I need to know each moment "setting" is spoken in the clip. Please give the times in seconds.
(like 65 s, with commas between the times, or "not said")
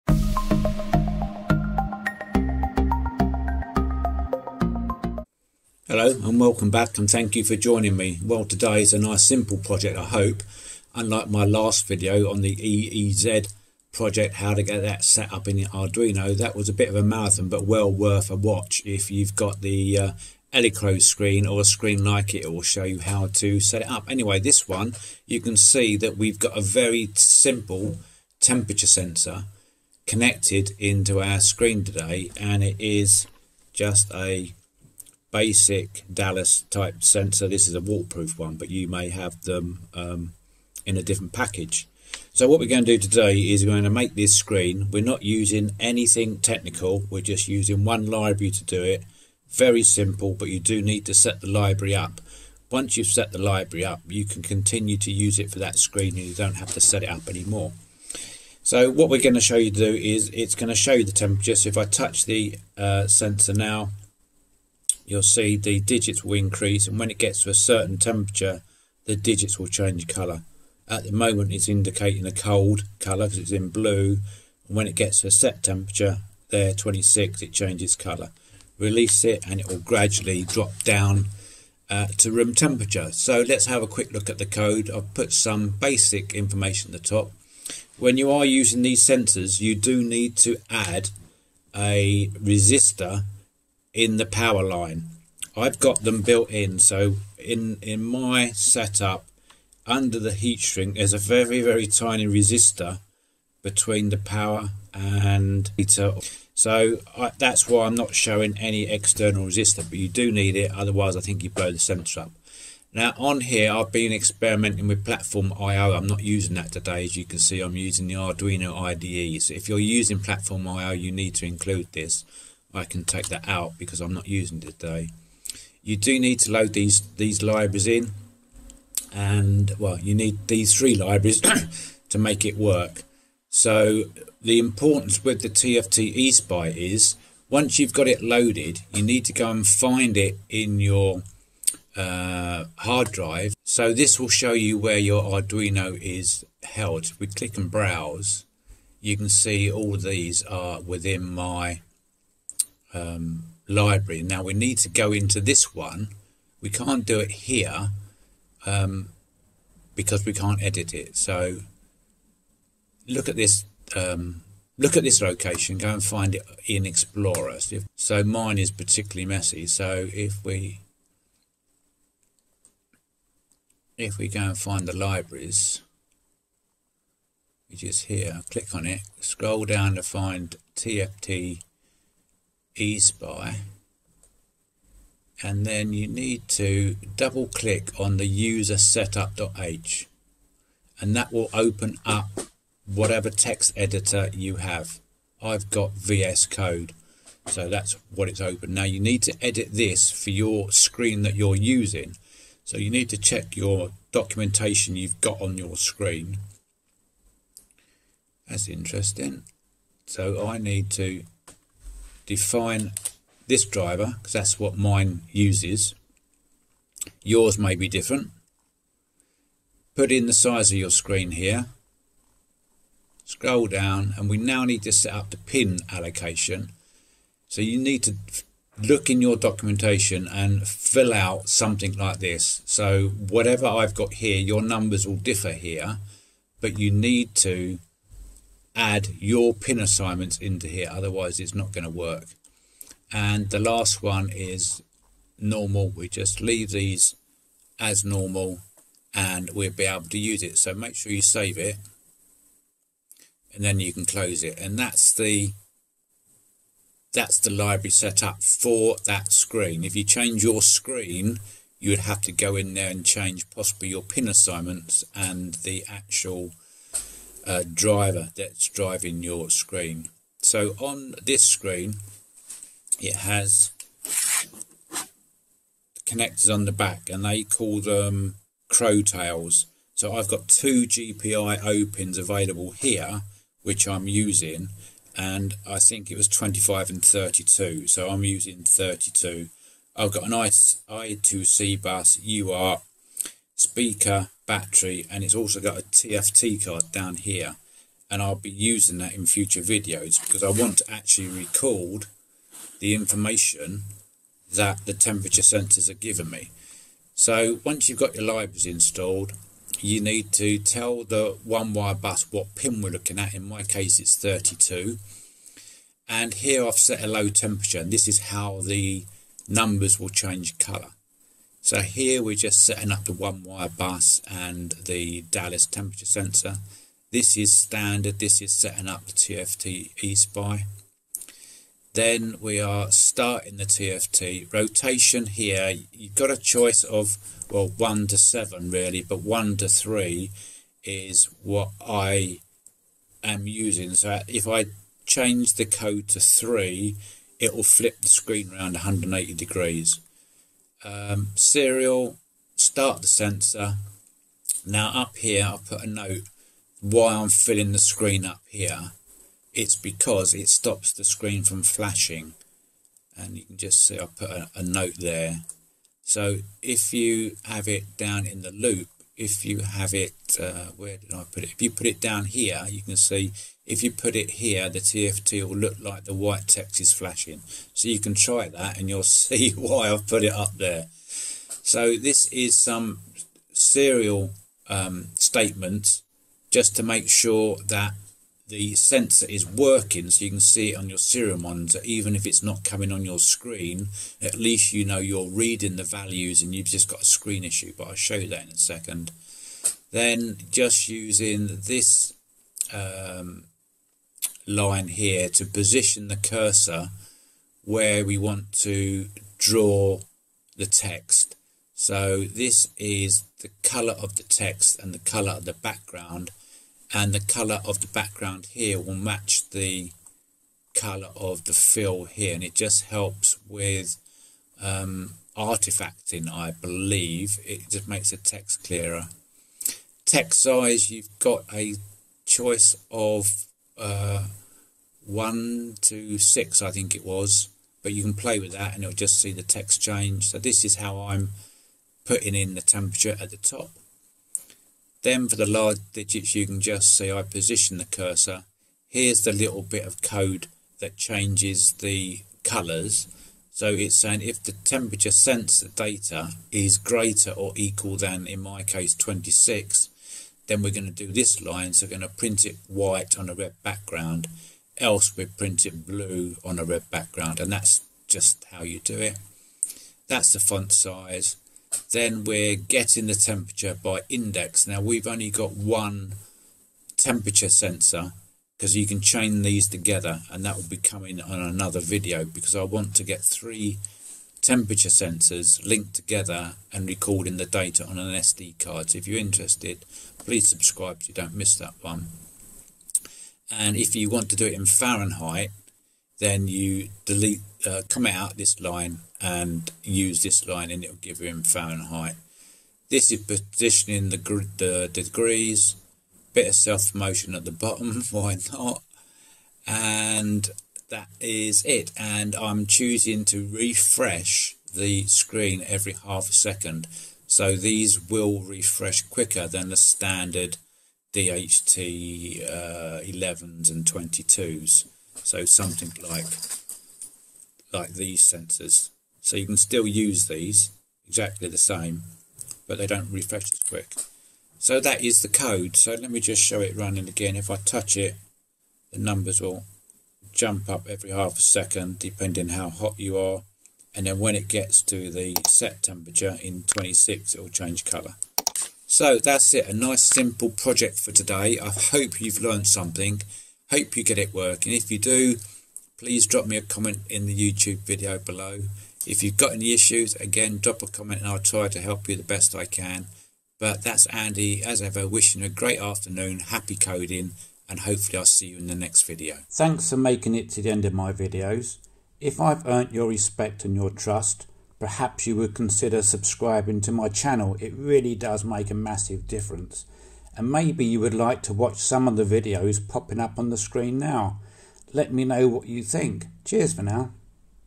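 322 s, 328 s.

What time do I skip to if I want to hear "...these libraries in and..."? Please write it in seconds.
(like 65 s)
127 s.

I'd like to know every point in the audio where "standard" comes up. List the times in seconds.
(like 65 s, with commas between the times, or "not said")
327 s, 519 s.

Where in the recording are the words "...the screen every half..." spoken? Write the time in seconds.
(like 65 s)
514 s.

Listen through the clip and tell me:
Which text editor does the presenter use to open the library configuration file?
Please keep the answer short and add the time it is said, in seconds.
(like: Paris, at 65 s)
VS Code, at 195 s.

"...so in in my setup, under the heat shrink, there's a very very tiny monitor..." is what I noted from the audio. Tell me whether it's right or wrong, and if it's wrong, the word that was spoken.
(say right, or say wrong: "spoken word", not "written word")
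wrong: "resistor", not "monitor".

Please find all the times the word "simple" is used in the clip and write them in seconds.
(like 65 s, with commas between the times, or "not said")
9 s, 27 s, 49 s, 550 s.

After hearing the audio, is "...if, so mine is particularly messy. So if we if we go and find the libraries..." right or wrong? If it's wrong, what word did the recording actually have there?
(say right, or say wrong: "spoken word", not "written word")
right.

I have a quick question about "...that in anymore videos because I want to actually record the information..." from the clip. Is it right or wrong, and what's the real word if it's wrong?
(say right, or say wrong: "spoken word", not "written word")
wrong: "future", not "anymore".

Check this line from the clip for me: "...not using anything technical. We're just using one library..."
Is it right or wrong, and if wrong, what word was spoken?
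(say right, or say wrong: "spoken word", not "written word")
right.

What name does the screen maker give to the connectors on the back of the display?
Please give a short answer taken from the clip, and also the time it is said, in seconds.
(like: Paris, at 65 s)
Crowtails, at 278 s.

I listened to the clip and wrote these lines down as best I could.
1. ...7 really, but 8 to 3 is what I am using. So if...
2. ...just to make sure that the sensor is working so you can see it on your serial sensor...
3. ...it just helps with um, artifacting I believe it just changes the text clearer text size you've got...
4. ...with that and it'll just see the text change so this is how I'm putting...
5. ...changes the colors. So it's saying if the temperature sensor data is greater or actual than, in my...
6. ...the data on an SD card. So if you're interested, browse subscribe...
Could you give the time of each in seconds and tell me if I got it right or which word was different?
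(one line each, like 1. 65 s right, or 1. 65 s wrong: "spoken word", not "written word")
1. 338 s wrong: "1", not "8"
2. 386 s wrong: "monitor", not "sensor"
3. 422 s wrong: "makes", not "changes"
4. 438 s right
5. 450 s wrong: "equal", not "actual"
6. 487 s wrong: "please", not "browse".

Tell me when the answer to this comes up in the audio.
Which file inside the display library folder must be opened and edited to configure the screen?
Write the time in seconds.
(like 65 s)
188 s.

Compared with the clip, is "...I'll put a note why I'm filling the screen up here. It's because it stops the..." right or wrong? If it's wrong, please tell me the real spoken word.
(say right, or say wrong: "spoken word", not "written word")
right.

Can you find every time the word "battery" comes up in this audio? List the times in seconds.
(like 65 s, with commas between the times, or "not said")
294 s.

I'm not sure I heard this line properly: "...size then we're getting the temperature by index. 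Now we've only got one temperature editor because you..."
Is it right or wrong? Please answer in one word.
wrong.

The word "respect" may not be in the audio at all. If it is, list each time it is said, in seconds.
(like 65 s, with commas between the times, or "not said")
573 s.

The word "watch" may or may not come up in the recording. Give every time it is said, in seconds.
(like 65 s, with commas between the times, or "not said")
18 s, 581 s.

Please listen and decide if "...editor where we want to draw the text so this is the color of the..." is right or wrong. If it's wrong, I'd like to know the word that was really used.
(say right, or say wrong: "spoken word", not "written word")
wrong: "cursor", not "editor".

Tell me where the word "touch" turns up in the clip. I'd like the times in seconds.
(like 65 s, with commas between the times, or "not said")
61 s, 537 s.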